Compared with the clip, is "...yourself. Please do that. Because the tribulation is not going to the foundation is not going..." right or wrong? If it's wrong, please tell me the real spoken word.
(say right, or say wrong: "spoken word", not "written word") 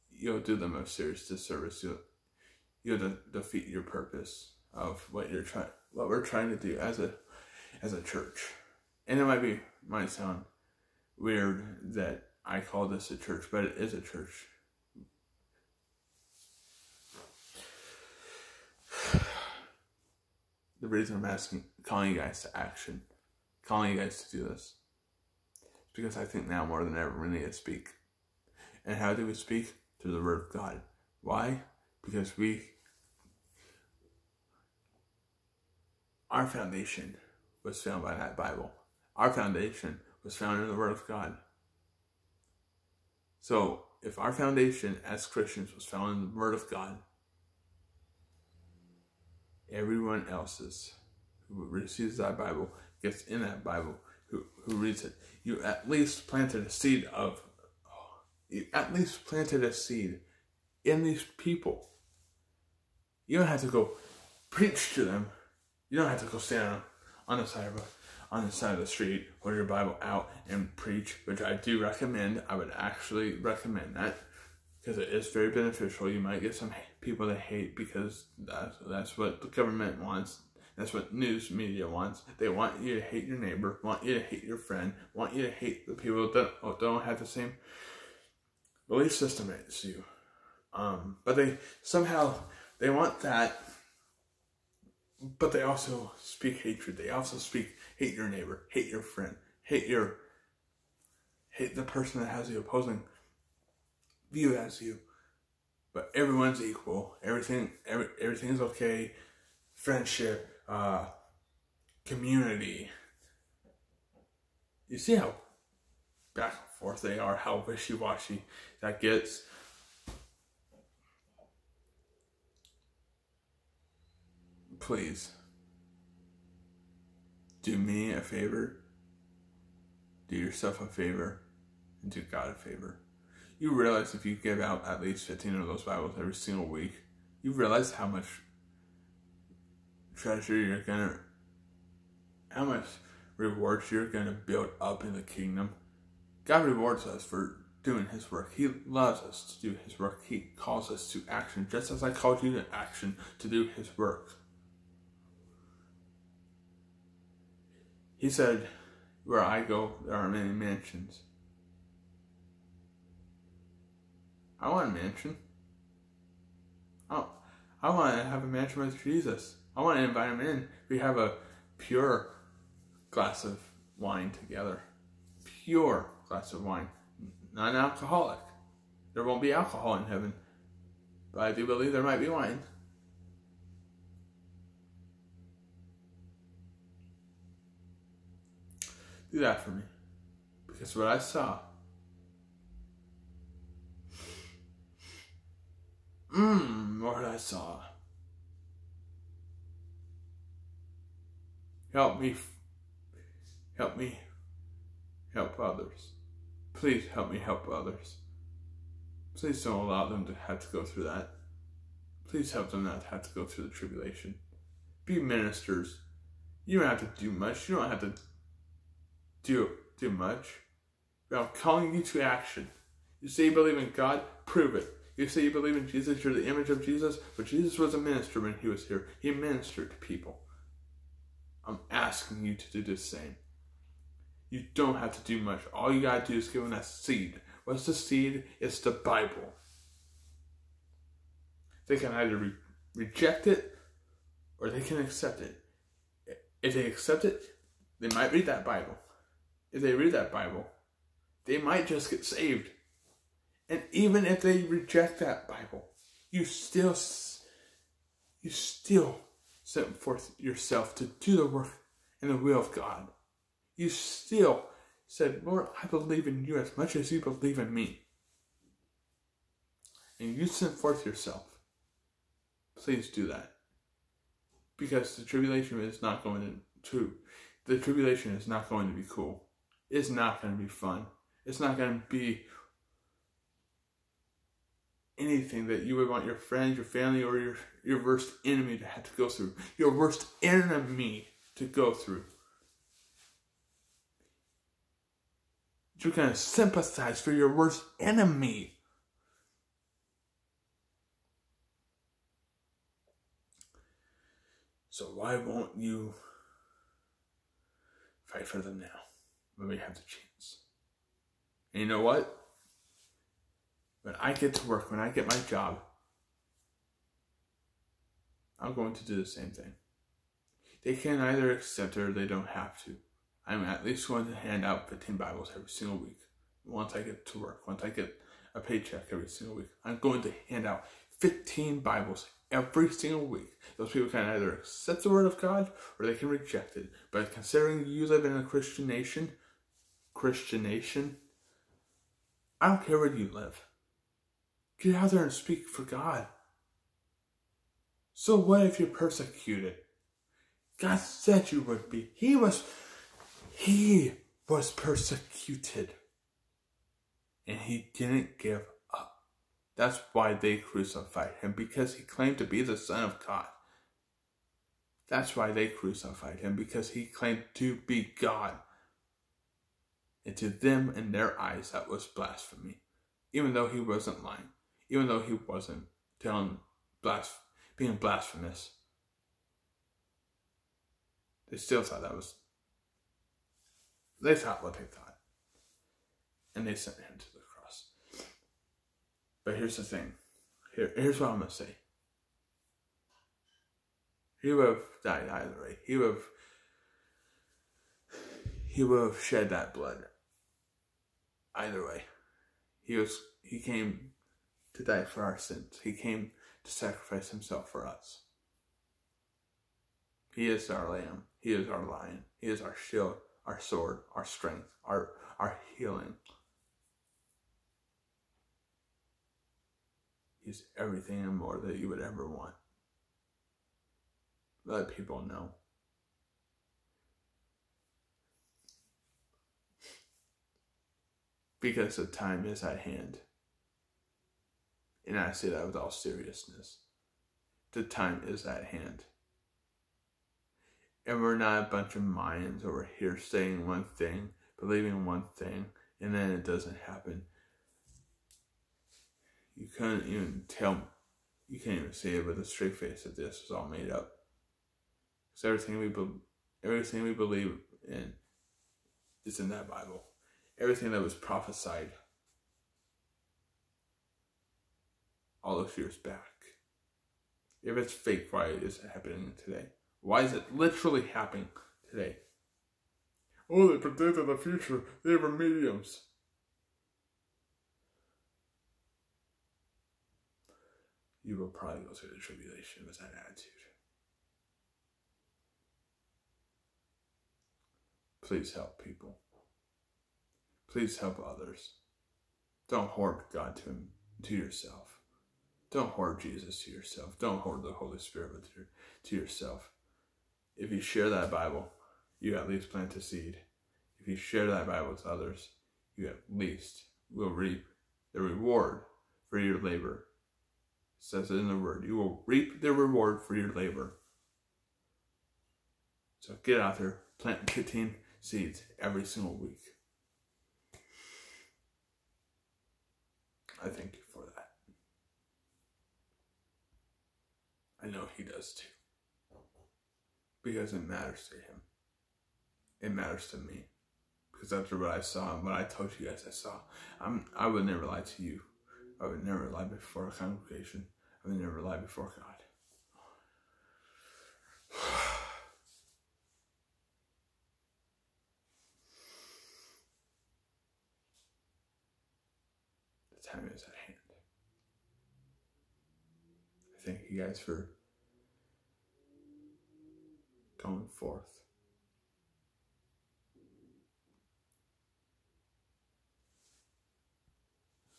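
wrong: "tribulation", not "foundation".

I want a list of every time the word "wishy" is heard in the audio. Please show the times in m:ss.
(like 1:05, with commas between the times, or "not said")
1:57.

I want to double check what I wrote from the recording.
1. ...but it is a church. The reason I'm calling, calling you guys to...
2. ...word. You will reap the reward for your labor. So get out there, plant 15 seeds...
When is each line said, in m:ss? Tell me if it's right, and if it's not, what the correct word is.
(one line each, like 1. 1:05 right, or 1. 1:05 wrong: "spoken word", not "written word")
1. 0:13 wrong: "asking", not "calling"
2. 8:31 right.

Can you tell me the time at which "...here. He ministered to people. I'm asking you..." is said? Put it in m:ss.
3:48.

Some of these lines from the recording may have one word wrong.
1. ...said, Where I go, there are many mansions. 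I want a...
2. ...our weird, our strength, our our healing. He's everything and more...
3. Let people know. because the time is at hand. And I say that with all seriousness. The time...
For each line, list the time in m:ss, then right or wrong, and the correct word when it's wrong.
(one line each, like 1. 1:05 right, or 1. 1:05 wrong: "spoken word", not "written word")
1. 2:38 right
2. 6:53 wrong: "sword", not "weird"
3. 7:04 right.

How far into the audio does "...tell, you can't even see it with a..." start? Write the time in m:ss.
7:30.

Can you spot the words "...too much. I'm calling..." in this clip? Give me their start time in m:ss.
3:39.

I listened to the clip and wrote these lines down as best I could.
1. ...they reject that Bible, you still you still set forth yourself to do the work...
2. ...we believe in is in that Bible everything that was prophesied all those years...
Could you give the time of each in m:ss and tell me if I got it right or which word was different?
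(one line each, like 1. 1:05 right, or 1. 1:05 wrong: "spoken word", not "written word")
1. 4:14 right
2. 7:37 right.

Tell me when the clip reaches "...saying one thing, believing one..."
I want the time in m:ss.
7:23.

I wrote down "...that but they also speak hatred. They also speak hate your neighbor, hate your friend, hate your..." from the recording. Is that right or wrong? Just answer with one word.
right.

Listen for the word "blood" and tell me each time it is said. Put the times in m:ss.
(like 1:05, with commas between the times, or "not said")
6:39.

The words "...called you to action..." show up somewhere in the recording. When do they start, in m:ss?
2:32.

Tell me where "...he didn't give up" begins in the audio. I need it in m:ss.
5:57.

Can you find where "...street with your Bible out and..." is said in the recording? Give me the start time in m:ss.
1:08.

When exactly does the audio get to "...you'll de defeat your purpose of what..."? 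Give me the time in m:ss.
0:02.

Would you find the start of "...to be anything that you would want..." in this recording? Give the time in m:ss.
4:42.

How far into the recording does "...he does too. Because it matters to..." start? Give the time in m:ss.
8:48.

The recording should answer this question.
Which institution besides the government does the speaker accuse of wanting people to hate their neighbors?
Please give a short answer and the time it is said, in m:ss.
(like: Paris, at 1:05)
news media, at 1:21.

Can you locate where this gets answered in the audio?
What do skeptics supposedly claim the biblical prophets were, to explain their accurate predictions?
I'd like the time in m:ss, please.
7:55.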